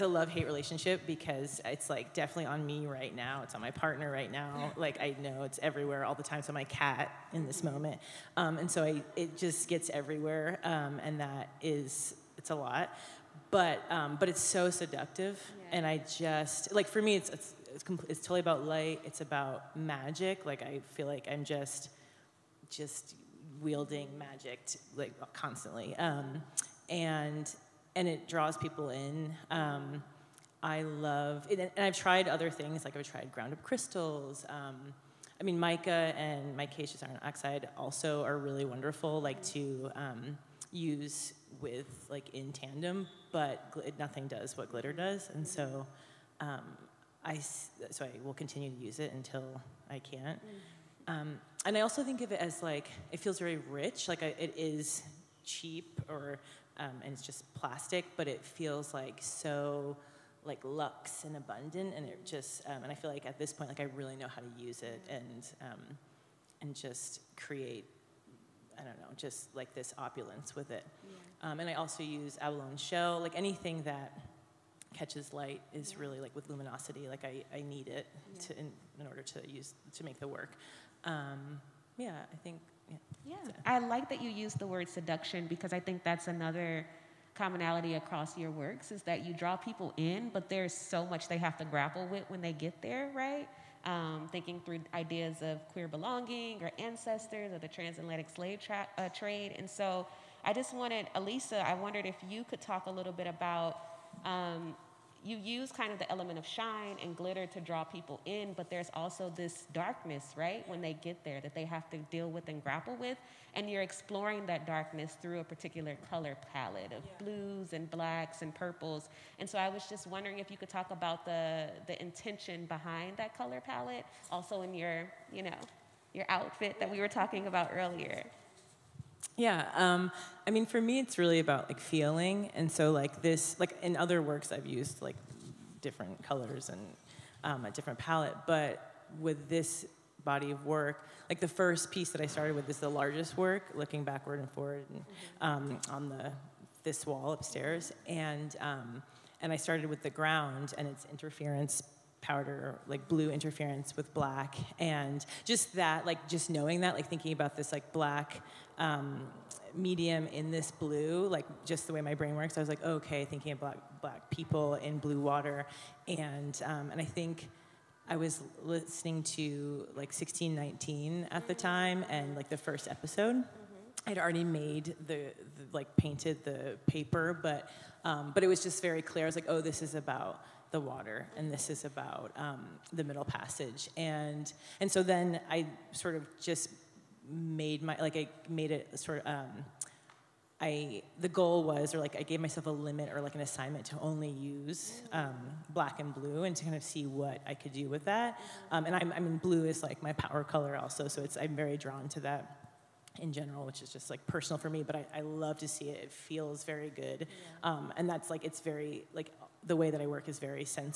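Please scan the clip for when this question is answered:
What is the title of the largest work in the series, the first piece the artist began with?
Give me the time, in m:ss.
2:23.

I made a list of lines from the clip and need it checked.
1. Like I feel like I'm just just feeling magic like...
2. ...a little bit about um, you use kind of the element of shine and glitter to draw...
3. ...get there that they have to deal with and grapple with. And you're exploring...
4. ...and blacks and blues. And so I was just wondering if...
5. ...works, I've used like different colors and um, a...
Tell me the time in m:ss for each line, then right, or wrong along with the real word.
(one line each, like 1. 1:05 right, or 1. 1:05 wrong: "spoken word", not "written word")
1. 0:20 wrong: "wielding", not "feeling"
2. 1:42 right
3. 1:51 right
4. 1:57 wrong: "purples", not "blues"
5. 2:14 right.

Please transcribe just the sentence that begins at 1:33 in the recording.
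um, thinking through ideas of queer belonging or ancestors or the transatlantic slave tra- uh, trade.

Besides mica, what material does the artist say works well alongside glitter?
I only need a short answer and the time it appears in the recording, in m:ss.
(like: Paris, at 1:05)
micaceous iron oxide, at 0:36.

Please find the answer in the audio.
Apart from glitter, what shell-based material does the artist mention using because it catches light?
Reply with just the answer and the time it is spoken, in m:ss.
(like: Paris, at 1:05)
abalone shell, at 1:12.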